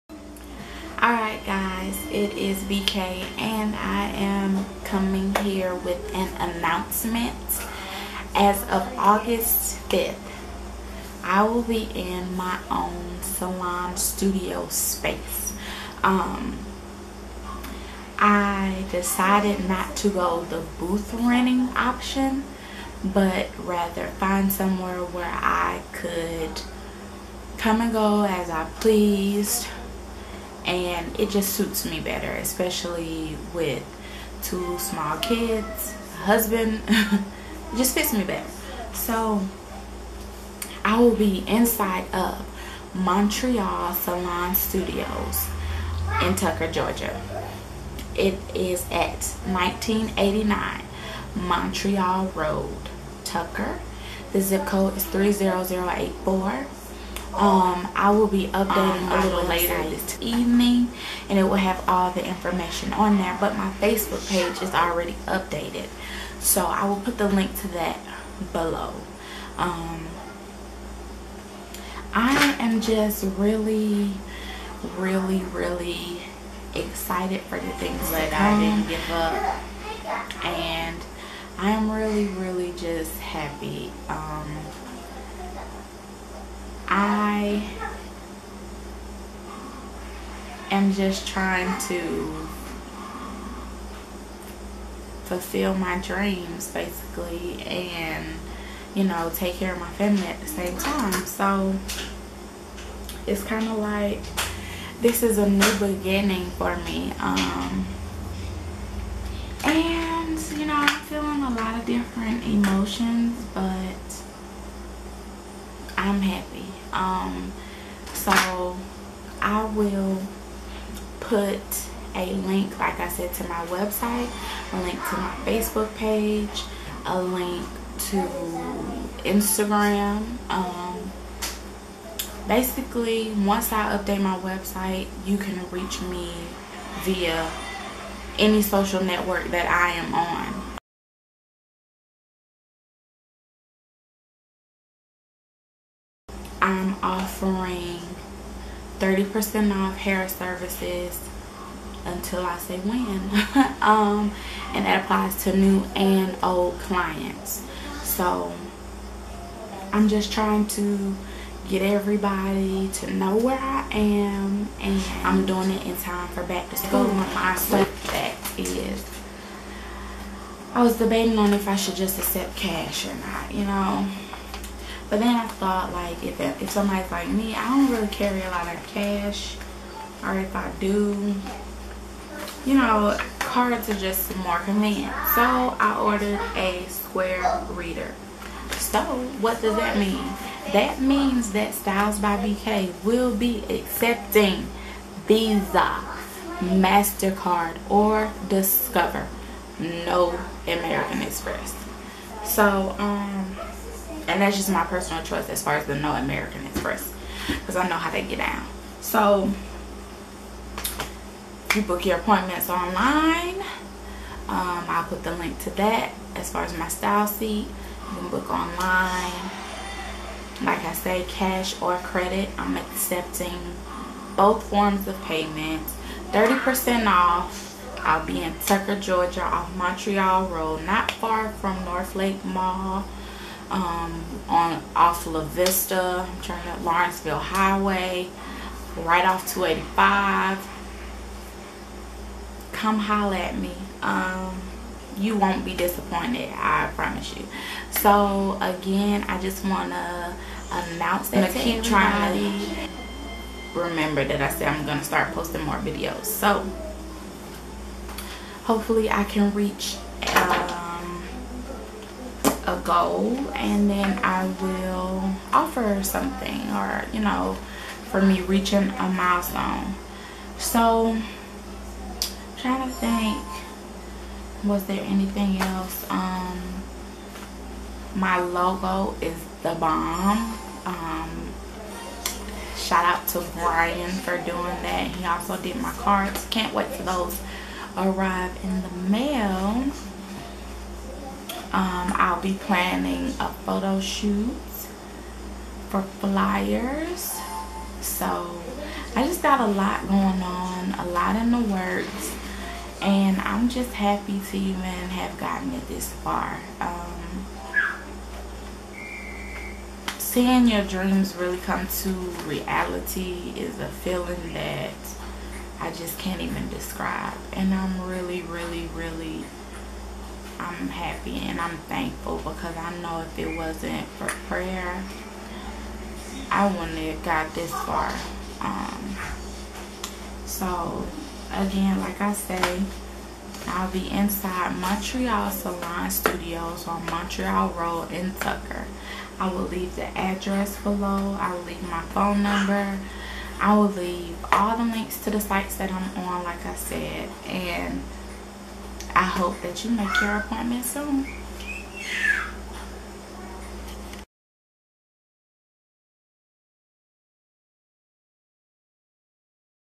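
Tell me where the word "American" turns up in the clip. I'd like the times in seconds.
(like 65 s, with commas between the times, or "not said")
200 s, 206 s.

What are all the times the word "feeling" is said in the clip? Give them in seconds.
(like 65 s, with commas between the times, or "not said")
111 s, 313 s.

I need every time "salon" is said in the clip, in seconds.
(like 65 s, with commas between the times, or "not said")
13 s, 43 s, 335 s.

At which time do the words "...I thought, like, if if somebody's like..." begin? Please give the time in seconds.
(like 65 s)
175 s.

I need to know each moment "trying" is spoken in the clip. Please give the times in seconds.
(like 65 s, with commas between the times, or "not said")
91 s, 160 s, 251 s, 272 s.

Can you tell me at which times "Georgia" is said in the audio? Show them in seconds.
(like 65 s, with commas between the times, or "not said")
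46 s, 228 s.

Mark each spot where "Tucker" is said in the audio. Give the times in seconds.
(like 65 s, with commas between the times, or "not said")
46 s, 53 s, 228 s, 338 s.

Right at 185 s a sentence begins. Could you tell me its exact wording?
So I ordered a square reader.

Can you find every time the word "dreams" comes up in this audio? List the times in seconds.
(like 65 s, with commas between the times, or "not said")
96 s, 310 s.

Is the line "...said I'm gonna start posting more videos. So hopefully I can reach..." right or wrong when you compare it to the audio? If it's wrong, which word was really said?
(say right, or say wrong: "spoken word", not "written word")
right.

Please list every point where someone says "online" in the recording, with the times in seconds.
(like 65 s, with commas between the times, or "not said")
212 s, 218 s.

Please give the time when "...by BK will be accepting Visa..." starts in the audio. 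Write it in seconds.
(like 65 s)
192 s.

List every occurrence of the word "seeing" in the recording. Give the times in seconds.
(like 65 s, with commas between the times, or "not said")
310 s.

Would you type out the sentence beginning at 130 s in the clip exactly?
Um, basically, once I update my website, you can reach me via any social network that I am on.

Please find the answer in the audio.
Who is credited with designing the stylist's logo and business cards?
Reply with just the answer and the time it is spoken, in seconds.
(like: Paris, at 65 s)
Brian, at 283 s.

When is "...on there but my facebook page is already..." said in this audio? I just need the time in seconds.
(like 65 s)
62 s.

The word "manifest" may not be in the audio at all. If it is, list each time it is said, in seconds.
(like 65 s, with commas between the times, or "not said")
not said.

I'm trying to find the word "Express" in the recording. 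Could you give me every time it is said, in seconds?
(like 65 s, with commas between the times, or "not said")
201 s, 206 s.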